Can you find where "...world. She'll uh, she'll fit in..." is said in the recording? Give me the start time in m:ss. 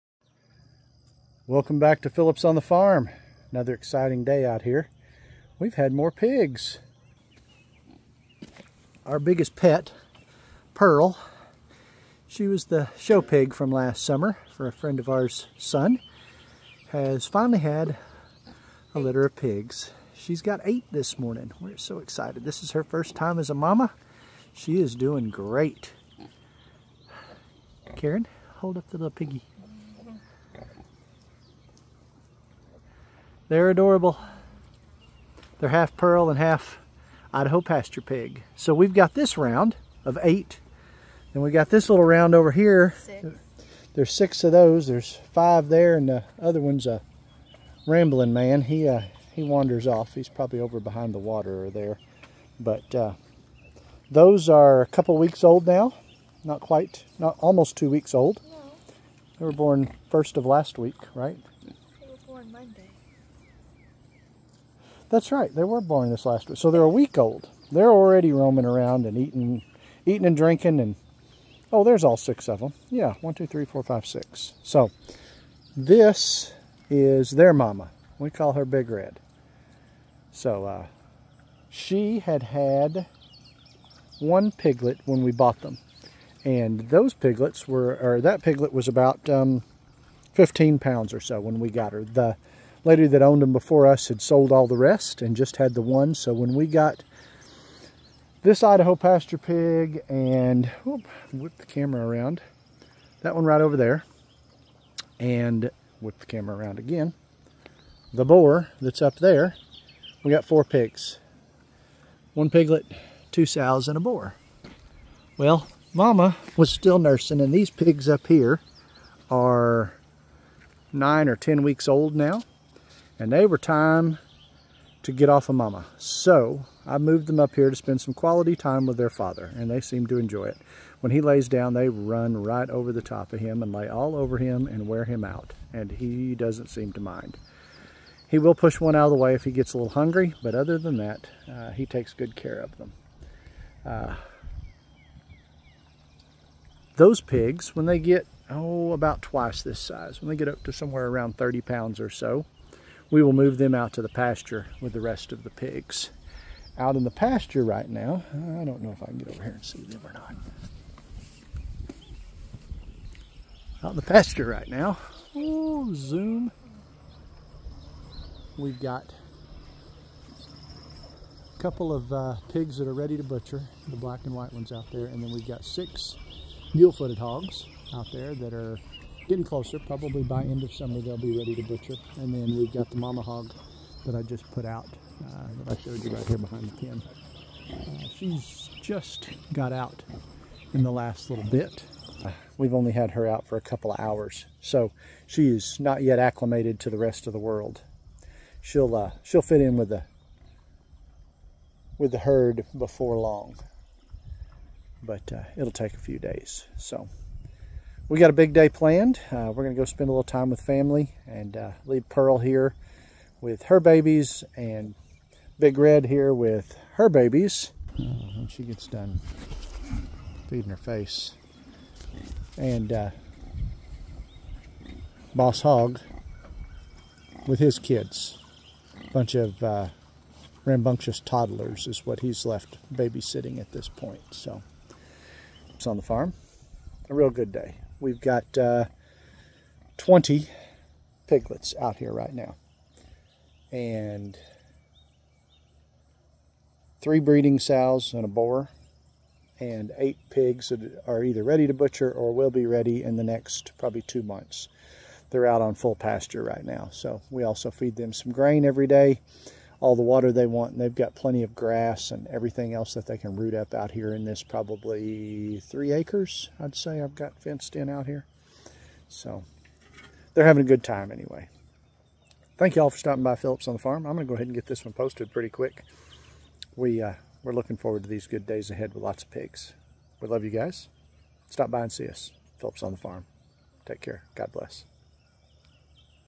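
3:17.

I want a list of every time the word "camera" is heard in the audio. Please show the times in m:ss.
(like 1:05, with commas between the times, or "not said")
1:41, 1:46.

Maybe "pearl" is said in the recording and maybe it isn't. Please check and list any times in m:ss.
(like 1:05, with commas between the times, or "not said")
0:10, 0:35, 3:32.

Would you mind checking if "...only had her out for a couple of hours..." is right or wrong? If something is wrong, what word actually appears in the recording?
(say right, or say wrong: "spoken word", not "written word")
right.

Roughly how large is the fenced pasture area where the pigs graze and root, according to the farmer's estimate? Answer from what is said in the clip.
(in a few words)
3 acres.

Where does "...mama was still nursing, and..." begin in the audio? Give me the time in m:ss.
1:55.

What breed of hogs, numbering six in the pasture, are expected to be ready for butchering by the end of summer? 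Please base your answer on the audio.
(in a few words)
mule-footed hogs.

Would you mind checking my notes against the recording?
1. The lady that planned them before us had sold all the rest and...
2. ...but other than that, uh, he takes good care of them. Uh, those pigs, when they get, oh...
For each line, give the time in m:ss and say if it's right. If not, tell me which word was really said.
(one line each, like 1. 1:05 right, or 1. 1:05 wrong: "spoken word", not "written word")
1. 1:32 wrong: "owned", not "planned"
2. 2:20 right.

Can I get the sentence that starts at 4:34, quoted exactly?
I'm going to go ahead and get this one posted pretty quick.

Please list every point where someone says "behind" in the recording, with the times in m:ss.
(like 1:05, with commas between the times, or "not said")
0:50, 3:06.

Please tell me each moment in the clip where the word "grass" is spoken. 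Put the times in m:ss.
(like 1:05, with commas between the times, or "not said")
4:21.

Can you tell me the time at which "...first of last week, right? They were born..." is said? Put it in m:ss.
1:00.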